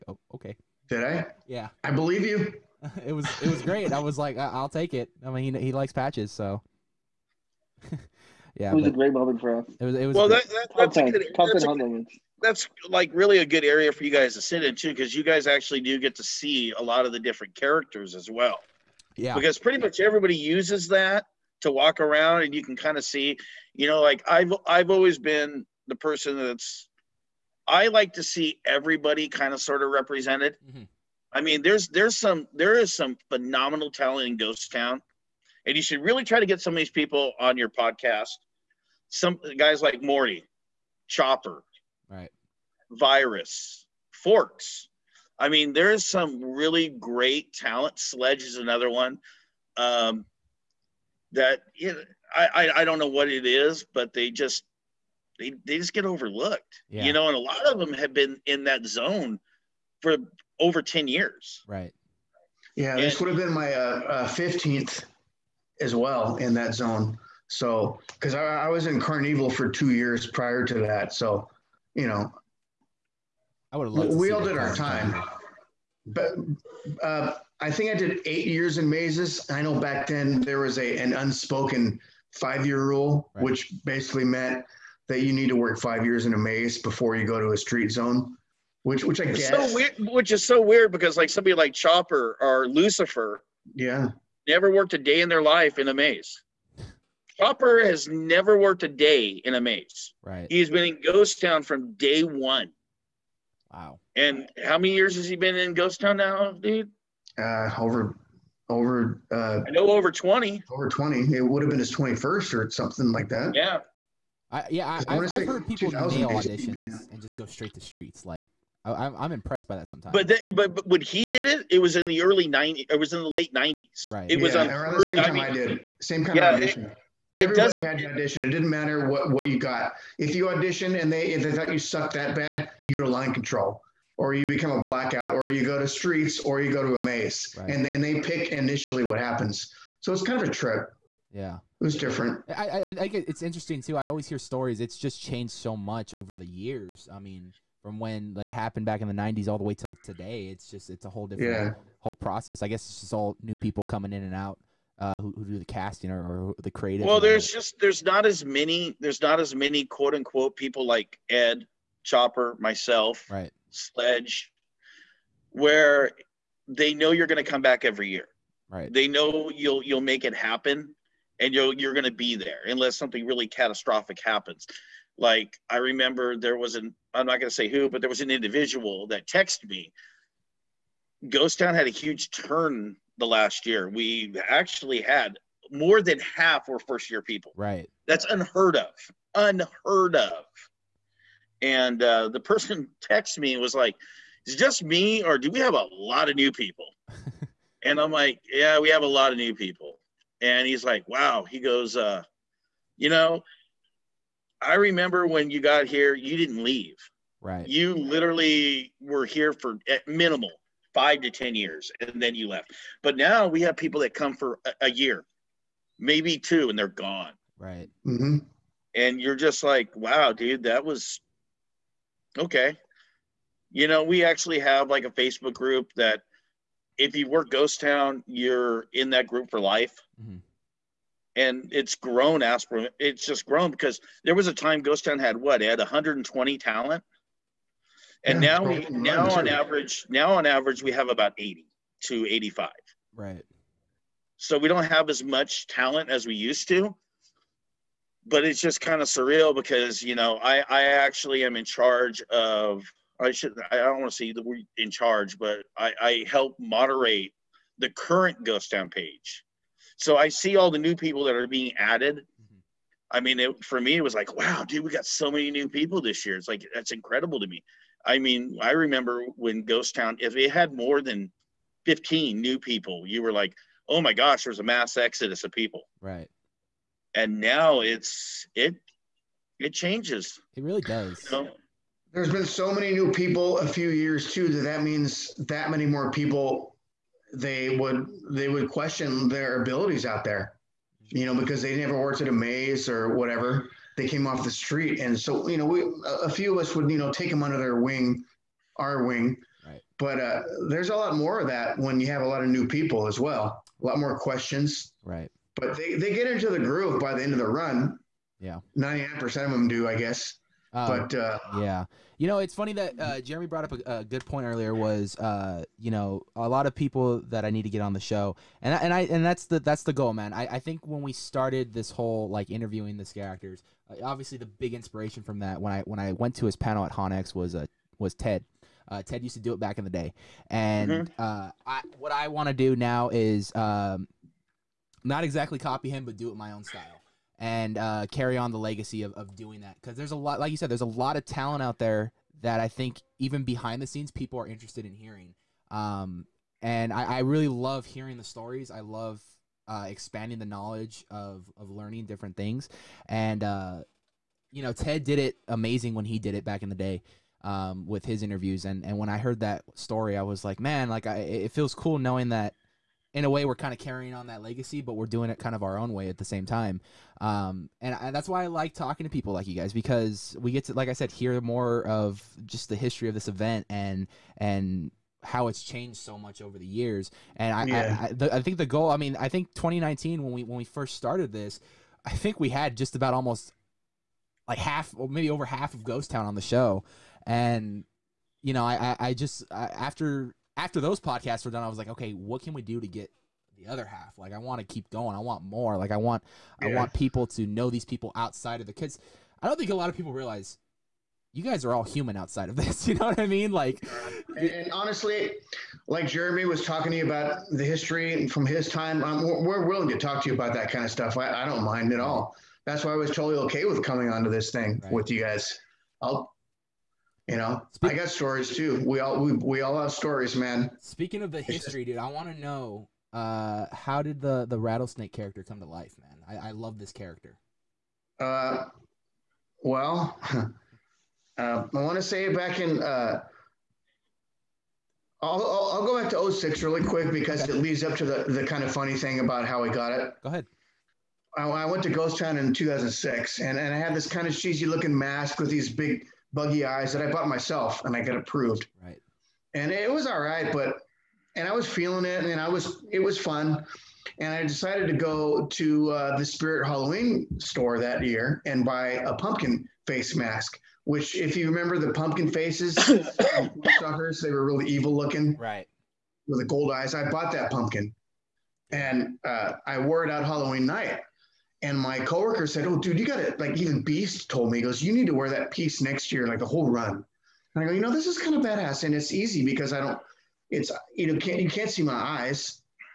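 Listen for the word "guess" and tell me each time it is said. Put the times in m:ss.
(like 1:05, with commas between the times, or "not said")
1:29, 2:32, 5:09.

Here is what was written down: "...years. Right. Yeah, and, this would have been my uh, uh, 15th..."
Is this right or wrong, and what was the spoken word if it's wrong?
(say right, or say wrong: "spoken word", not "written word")
right.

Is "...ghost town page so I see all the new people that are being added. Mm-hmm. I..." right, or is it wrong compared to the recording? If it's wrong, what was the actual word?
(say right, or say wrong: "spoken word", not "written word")
right.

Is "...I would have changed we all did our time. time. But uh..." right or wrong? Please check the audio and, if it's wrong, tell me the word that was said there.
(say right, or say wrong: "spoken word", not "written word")
wrong: "loved", not "changed".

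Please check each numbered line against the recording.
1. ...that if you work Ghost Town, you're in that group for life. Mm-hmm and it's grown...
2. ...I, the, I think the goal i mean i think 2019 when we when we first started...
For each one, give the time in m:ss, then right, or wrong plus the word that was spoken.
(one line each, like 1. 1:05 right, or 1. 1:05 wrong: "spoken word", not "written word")
1. 3:45 right
2. 6:18 right.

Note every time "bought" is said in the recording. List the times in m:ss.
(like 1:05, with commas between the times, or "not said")
7:27, 7:47.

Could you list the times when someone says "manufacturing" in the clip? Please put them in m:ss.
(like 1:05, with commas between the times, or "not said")
not said.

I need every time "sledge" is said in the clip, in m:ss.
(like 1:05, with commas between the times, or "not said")
0:47, 2:43.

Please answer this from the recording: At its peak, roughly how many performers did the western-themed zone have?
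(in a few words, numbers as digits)
120.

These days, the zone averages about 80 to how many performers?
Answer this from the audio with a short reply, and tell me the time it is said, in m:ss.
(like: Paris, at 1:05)
85, at 4:02.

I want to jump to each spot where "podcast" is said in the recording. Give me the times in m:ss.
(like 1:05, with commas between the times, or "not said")
0:37, 6:30.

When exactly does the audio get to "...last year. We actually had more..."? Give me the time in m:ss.
3:03.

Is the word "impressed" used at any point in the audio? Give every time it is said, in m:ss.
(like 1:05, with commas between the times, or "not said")
1:59.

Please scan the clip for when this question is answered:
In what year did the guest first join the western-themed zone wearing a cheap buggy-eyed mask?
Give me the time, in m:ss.
7:22.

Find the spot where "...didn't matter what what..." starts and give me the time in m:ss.
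2:08.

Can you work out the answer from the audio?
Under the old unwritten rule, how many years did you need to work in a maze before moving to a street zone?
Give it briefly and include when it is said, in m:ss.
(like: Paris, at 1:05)
5, at 1:22.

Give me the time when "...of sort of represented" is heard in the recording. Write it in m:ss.
0:29.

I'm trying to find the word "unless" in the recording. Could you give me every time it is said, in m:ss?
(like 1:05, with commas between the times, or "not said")
2:52.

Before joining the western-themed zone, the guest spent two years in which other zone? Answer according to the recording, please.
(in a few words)
Carnival.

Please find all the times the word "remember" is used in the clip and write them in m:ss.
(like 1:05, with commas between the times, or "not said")
2:55, 3:24, 4:28, 7:41.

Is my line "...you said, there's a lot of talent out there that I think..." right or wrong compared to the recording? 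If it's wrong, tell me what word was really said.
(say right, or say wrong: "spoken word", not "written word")
right.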